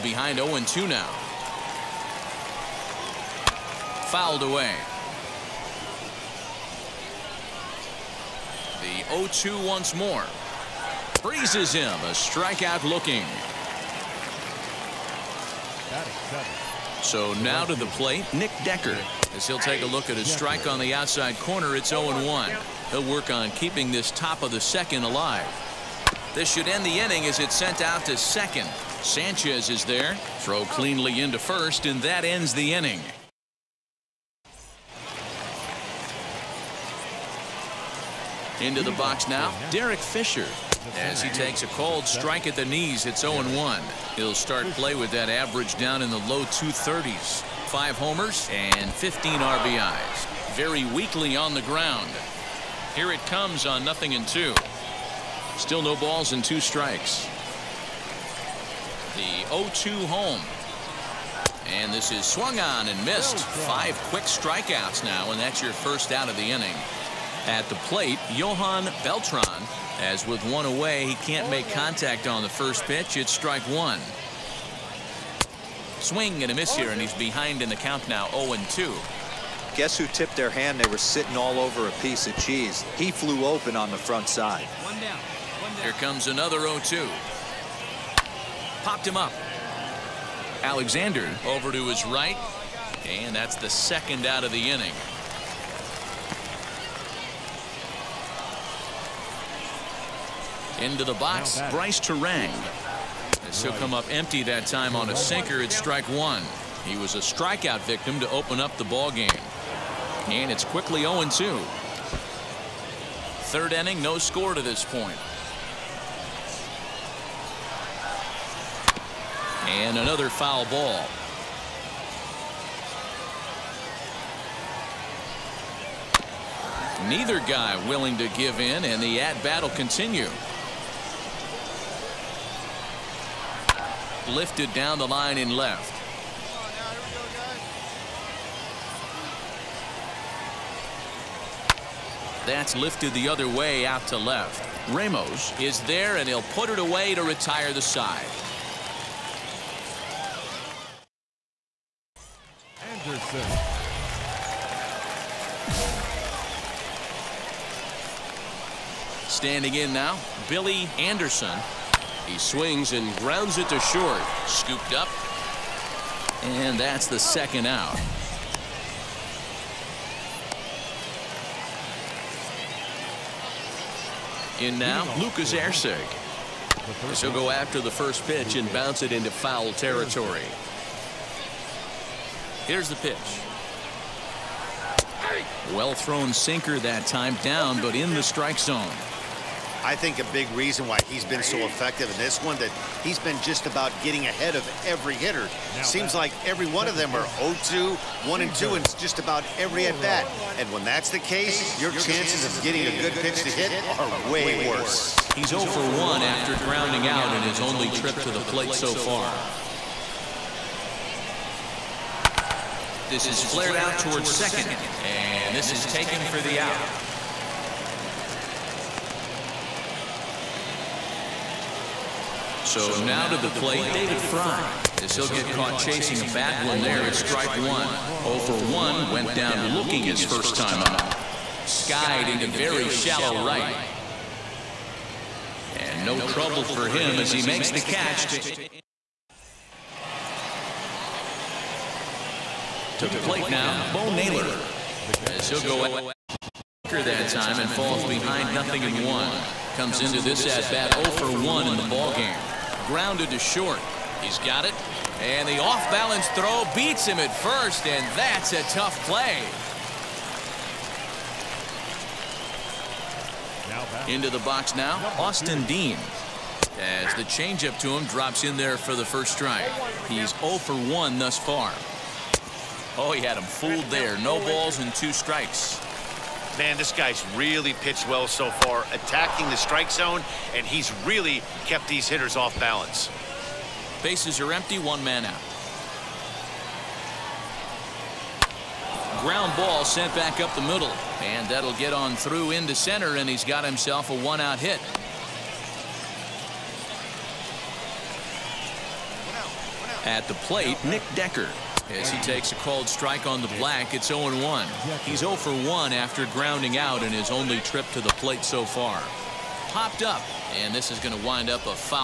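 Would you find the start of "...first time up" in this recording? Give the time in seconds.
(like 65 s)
230 s.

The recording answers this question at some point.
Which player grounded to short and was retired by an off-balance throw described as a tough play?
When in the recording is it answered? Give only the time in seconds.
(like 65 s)
243 s.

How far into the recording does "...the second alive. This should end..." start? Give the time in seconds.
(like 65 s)
24 s.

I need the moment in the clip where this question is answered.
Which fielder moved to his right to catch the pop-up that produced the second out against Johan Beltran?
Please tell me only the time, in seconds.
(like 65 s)
90 s.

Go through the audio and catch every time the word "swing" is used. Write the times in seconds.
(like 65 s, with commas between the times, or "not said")
75 s, 162 s.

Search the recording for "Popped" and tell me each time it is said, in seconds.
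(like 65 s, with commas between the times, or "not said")
88 s, 309 s.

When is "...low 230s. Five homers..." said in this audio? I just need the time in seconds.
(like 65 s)
46 s.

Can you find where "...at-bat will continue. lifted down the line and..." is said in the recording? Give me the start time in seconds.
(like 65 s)
129 s.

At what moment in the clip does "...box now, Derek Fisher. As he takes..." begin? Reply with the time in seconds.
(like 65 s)
38 s.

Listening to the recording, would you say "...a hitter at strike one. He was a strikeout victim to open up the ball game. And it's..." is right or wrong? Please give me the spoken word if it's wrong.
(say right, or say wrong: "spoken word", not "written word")
wrong: "sinker", not "hitter".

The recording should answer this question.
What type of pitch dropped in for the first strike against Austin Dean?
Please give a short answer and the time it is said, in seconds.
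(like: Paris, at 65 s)
changeup, at 267 s.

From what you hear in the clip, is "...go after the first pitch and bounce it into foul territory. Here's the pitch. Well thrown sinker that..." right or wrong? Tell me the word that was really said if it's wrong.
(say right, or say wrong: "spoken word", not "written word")
right.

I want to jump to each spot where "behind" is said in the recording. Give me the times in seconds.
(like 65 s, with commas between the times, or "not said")
0 s, 77 s, 248 s.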